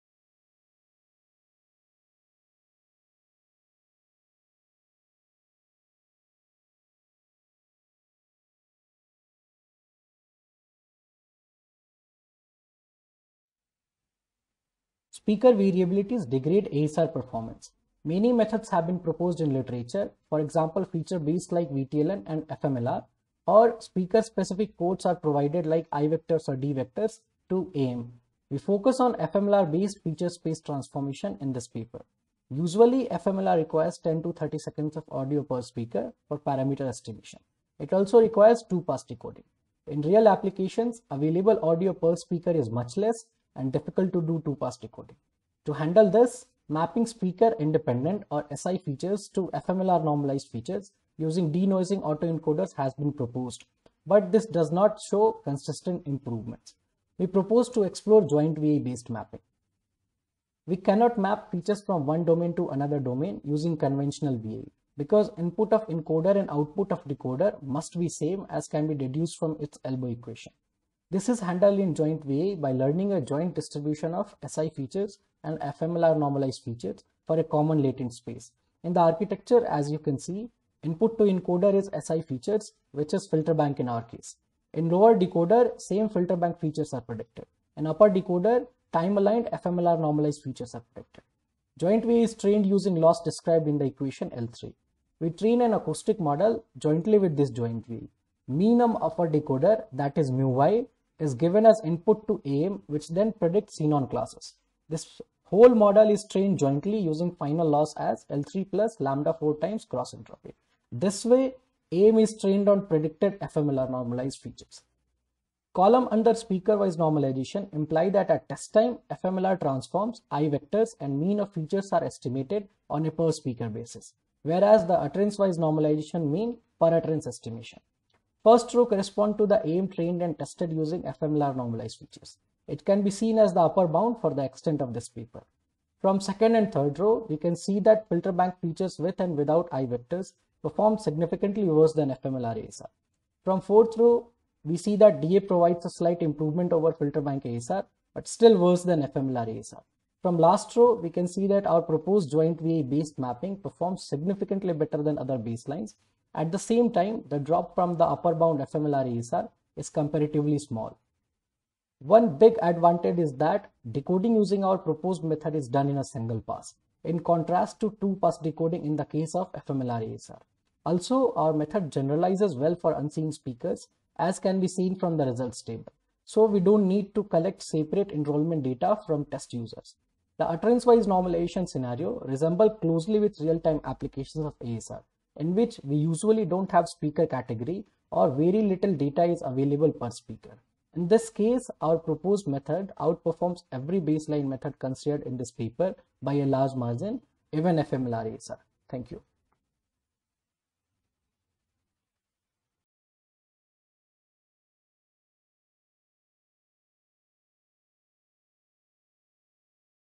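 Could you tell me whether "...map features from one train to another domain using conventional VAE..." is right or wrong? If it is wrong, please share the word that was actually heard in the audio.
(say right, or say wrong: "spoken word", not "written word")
wrong: "domain", not "train".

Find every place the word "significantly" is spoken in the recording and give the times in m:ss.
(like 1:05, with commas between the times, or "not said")
2:20, 2:34.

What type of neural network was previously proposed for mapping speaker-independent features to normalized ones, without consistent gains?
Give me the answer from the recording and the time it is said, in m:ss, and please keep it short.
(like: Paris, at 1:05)
denoising autoencoders, at 0:51.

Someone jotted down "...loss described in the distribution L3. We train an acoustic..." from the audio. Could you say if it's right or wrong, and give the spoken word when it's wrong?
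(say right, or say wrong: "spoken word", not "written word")
wrong: "equation", not "distribution".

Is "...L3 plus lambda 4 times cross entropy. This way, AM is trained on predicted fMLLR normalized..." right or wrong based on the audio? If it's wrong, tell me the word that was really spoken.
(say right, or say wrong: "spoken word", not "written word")
right.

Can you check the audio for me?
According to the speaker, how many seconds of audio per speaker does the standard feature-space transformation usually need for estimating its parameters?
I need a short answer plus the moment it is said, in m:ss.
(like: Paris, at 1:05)
10 to 30 seconds, at 0:33.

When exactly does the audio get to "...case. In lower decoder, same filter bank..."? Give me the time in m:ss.
1:24.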